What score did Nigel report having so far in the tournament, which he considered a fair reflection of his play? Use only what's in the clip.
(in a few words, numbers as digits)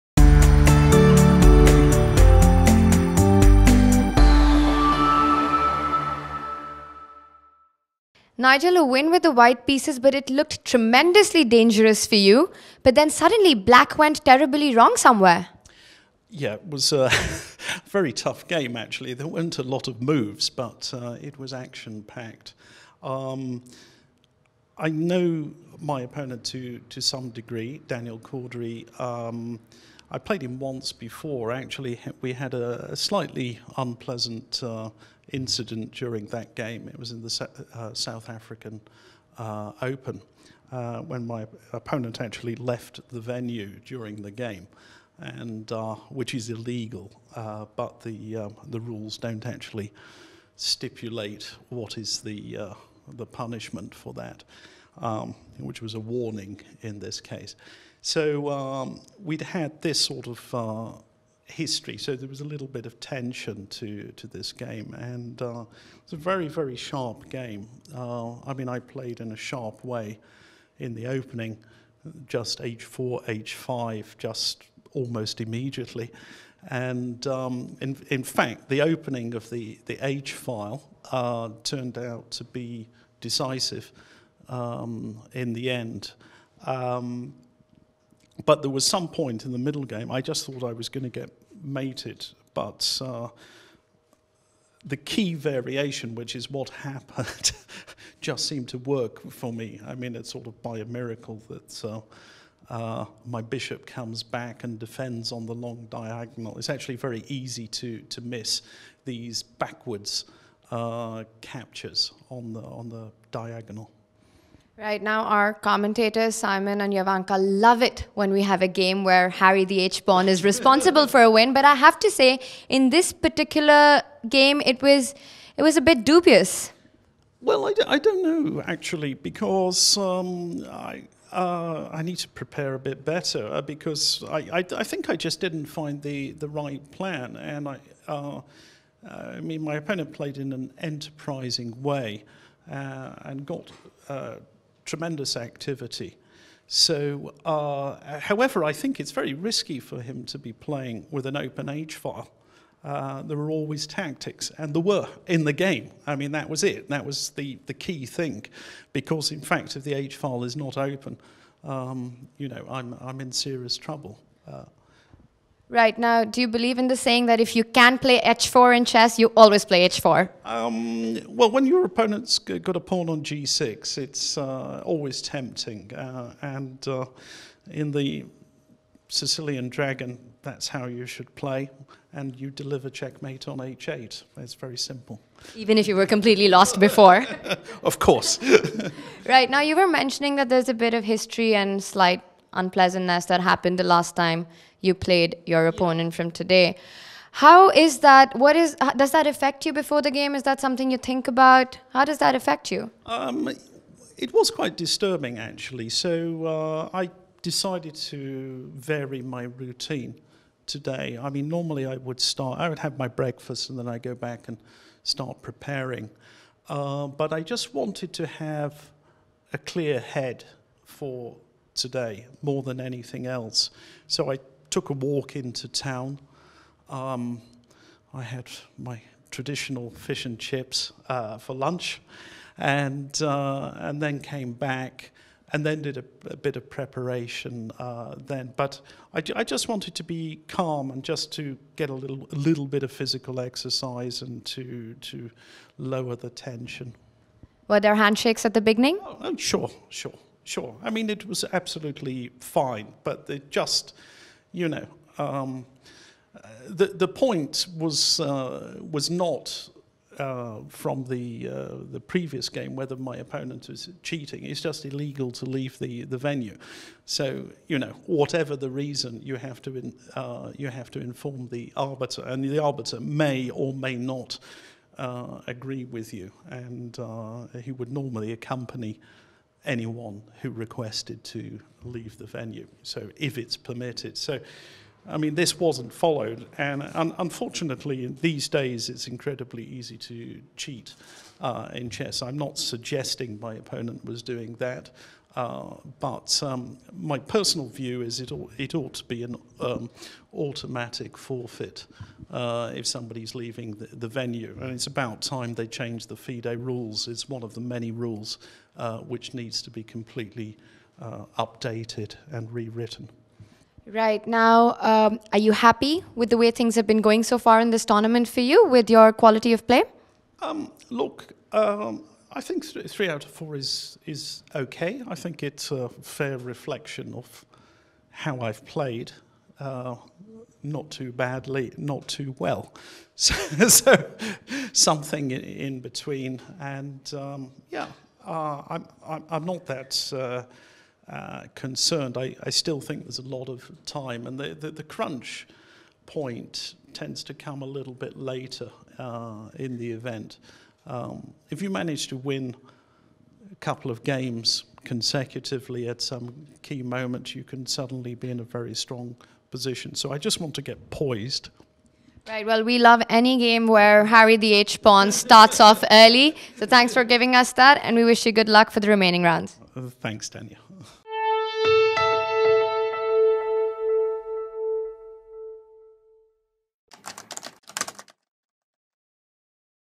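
3 out of 4.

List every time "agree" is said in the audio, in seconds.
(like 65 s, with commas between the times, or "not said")
275 s.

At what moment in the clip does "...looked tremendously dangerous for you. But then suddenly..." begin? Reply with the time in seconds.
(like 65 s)
10 s.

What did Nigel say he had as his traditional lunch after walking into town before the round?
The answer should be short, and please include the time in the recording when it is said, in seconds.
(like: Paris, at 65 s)
Fish and chips, at 229 s.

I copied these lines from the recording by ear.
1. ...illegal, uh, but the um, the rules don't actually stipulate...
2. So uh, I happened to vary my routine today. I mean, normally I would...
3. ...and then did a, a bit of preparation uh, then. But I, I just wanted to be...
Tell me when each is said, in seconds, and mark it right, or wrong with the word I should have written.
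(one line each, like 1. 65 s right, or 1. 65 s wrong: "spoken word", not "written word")
1. 46 s right
2. 205 s wrong: "decided", not "happened"
3. 235 s right.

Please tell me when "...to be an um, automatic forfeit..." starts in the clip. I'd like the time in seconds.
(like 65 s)
298 s.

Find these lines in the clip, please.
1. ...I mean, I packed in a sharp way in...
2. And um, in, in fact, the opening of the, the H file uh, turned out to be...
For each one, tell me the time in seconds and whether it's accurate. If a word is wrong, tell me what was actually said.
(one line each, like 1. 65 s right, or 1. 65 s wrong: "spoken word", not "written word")
1. 68 s wrong: "played", not "packed"
2. 76 s right.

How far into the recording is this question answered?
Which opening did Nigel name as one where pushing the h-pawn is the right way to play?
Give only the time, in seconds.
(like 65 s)
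179 s.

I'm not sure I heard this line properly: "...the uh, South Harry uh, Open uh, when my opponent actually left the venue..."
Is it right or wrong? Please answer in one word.
wrong.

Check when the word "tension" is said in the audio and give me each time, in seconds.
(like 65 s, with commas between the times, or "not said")
62 s, 246 s.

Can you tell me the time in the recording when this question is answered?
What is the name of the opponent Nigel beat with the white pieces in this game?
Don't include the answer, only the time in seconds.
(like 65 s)
27 s.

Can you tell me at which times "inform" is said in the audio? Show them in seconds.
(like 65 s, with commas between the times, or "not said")
270 s.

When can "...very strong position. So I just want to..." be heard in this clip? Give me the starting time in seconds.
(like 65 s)
358 s.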